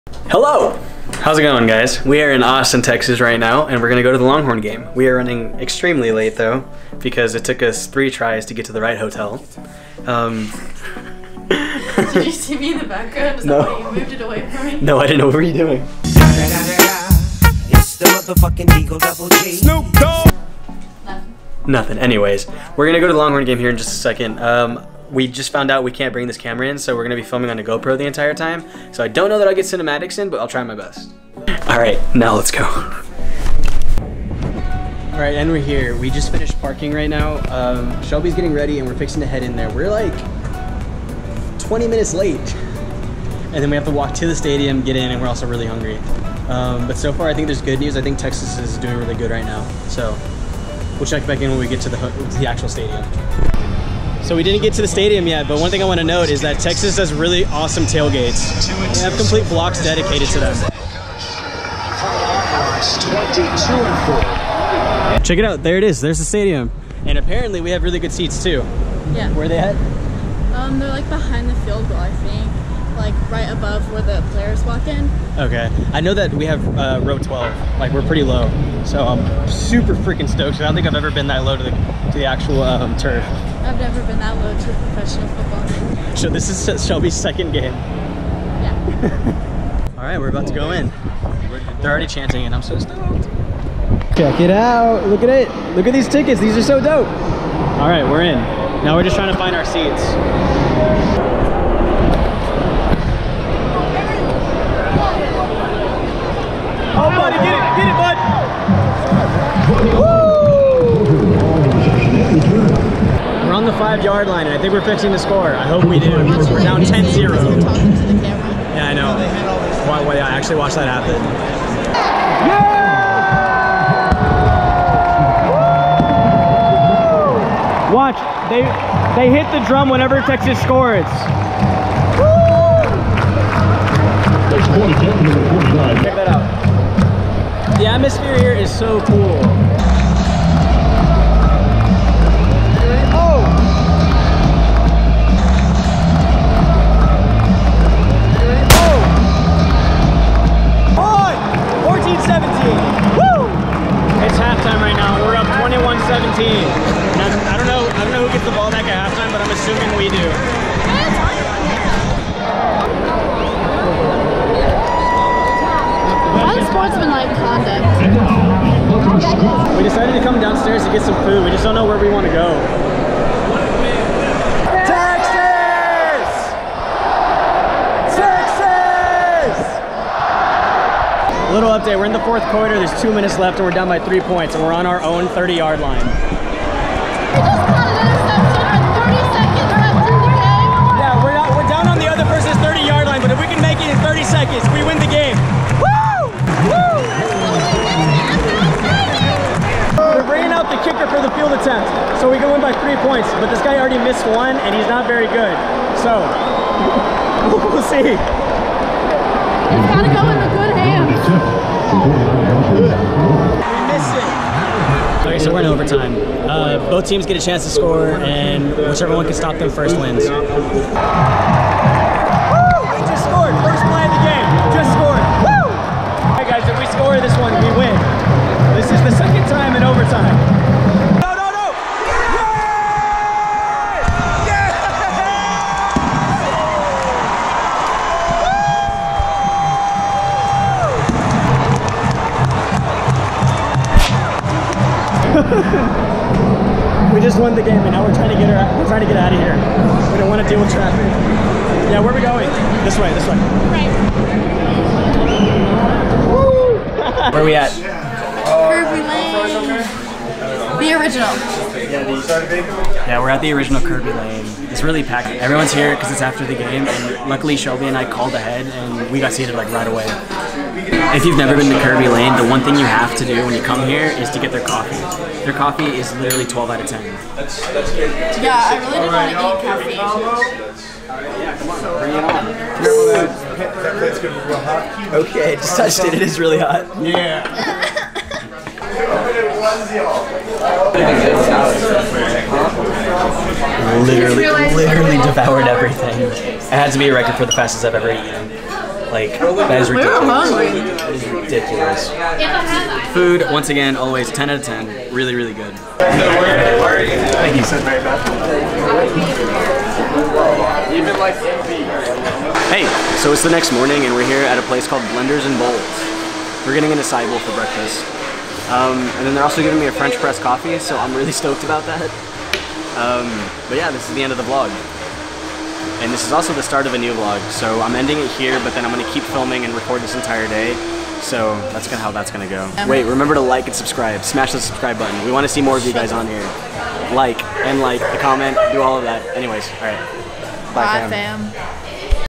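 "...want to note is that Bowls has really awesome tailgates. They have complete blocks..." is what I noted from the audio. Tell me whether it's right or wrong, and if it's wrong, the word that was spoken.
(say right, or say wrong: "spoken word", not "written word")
wrong: "Texas", not "Bowls".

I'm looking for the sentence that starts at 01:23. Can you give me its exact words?
I've never been that low to professional football.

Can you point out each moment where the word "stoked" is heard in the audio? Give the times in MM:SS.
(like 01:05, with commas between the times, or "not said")
01:20, 01:32, 05:21.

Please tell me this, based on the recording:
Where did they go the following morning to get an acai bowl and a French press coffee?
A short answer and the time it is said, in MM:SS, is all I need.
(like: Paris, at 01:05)
Blenders and Bowls, at 05:15.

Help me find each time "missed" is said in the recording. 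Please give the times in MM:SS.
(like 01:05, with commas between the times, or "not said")
03:23, 03:33.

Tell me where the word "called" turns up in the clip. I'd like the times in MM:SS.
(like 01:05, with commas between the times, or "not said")
04:28, 05:14.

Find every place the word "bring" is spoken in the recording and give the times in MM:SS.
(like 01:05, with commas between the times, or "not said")
00:26, 04:43.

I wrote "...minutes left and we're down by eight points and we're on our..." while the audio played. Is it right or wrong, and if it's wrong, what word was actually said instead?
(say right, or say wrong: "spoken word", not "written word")
wrong: "three", not "eight".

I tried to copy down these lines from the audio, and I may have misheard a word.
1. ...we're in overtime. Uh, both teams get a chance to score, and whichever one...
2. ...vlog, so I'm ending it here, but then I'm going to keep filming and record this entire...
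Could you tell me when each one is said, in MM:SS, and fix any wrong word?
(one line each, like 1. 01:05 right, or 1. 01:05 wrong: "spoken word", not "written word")
1. 03:35 right
2. 05:27 right.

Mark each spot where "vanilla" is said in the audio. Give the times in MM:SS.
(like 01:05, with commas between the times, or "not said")
not said.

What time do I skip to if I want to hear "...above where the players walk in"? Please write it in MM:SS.
01:13.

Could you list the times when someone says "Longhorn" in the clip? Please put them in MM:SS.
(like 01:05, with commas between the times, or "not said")
00:04, 00:23.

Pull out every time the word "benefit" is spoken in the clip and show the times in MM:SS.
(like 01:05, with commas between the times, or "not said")
not said.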